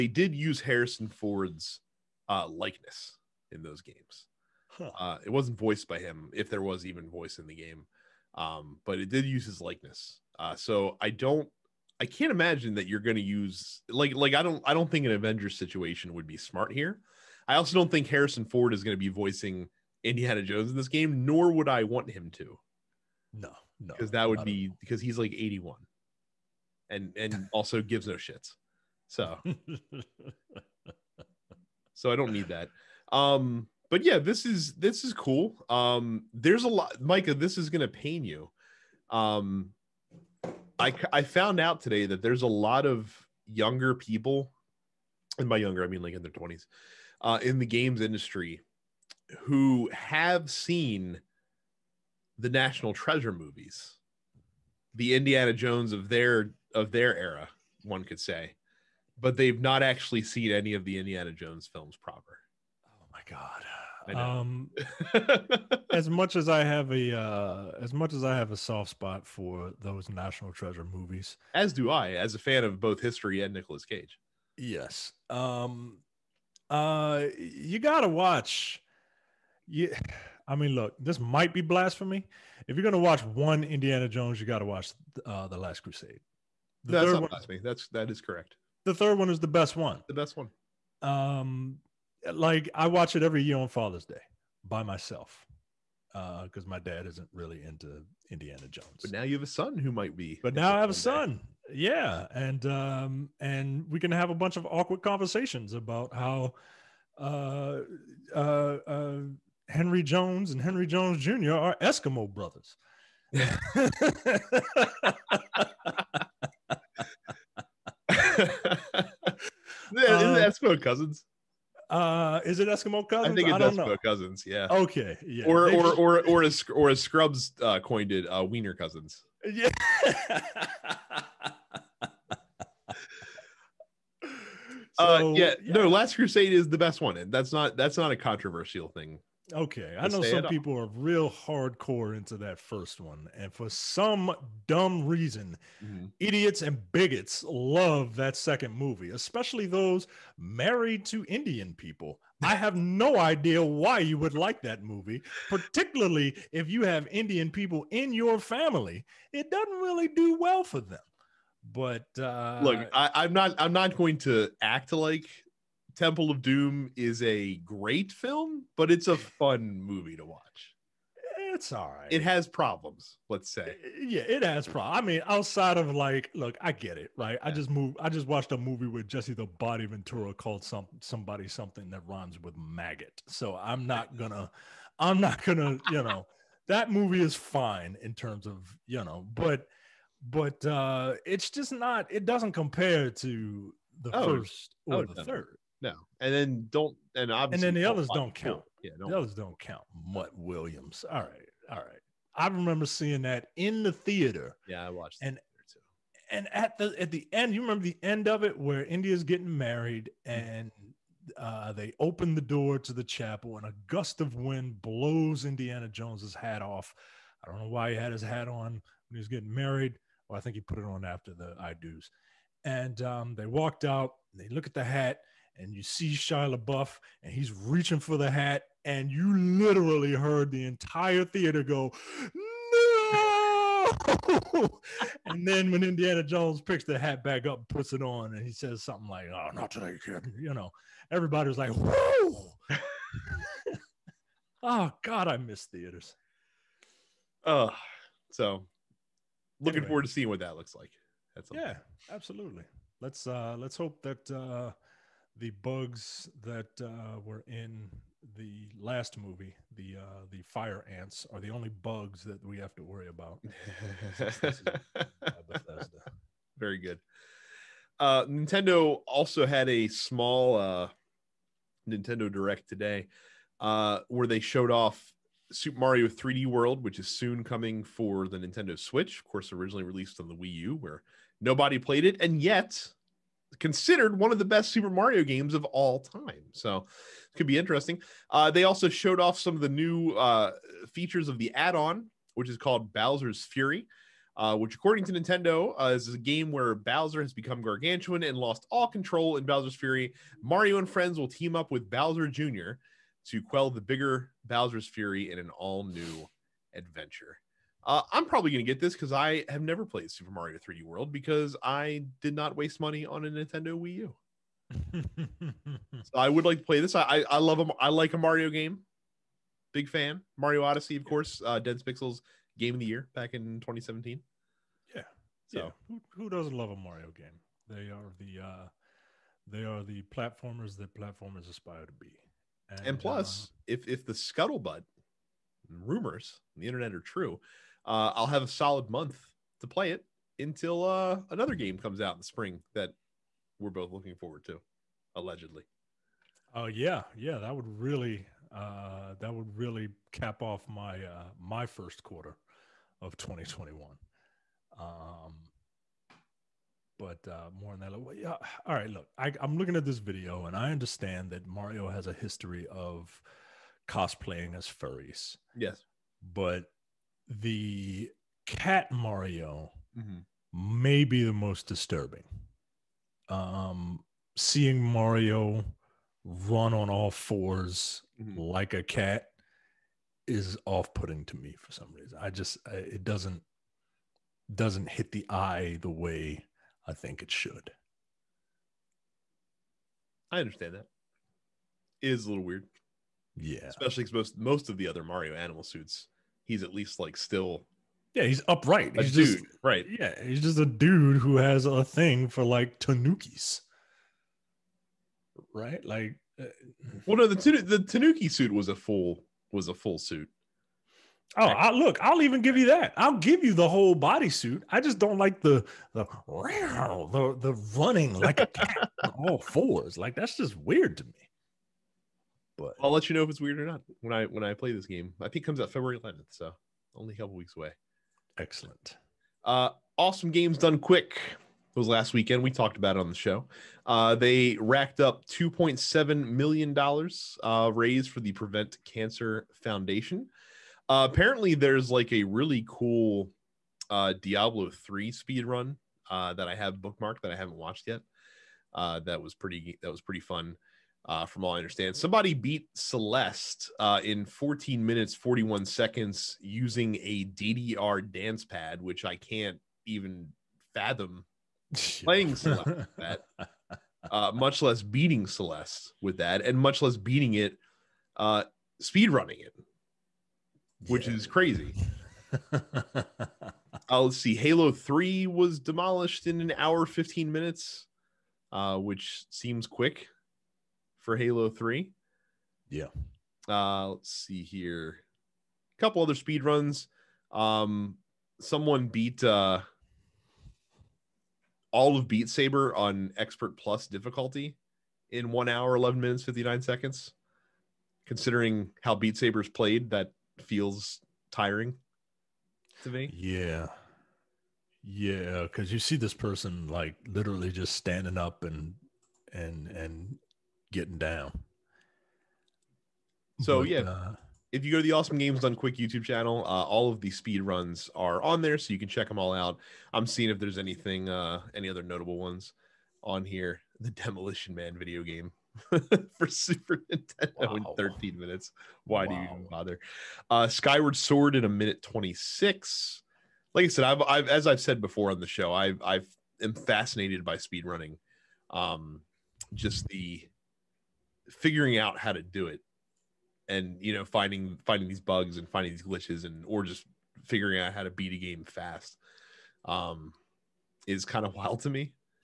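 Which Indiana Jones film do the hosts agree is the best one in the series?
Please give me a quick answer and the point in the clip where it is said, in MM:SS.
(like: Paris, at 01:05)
The Last Crusade, at 01:25.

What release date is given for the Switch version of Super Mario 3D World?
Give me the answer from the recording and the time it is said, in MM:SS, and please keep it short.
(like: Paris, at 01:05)
February 11th, at 07:05.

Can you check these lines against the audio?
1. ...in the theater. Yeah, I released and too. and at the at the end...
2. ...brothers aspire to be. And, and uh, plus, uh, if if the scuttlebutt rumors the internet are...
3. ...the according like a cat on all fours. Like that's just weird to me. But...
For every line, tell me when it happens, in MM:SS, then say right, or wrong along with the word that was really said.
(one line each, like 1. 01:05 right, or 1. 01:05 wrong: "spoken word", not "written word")
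1. 03:23 wrong: "watched", not "released"
2. 05:30 wrong: "platformers", not "brothers"
3. 06:57 wrong: "running", not "according".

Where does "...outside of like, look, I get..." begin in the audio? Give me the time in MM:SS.
02:55.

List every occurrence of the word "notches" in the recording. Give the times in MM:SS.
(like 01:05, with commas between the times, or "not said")
not said.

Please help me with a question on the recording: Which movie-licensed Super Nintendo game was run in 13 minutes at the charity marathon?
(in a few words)
Demolition Man.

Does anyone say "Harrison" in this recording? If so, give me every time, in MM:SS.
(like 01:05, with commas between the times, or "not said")
00:00, 00:18.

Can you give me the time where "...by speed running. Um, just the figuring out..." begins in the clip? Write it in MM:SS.
08:57.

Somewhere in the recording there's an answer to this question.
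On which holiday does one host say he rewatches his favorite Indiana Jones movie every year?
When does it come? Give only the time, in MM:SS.
01:33.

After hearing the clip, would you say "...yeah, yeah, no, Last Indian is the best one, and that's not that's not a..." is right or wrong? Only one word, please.
wrong.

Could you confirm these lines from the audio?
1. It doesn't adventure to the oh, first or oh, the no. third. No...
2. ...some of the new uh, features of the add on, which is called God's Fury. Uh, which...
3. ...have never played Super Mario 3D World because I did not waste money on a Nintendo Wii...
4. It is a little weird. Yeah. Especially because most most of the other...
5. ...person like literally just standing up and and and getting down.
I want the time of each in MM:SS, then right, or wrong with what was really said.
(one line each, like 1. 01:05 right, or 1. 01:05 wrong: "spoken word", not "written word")
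1. 03:12 wrong: "compare", not "adventure"
2. 04:49 wrong: "Bowser", not "God"
3. 05:09 right
4. 06:32 right
5. 08:26 right.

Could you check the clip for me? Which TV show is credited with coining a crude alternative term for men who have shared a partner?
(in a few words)
Scrubs.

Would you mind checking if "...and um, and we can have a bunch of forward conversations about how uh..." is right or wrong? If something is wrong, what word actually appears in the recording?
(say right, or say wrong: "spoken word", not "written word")
wrong: "awkward", not "forward".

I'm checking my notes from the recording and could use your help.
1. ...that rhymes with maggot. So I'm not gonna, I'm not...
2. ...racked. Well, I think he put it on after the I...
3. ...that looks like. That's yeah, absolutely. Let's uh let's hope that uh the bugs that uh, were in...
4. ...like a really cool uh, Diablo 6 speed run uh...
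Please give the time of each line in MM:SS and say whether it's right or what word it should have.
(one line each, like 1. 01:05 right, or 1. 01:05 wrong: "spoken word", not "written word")
1. 03:01 right
2. 03:39 wrong: "married", not "racked"
3. 04:10 right
4. 07:21 wrong: "3", not "6".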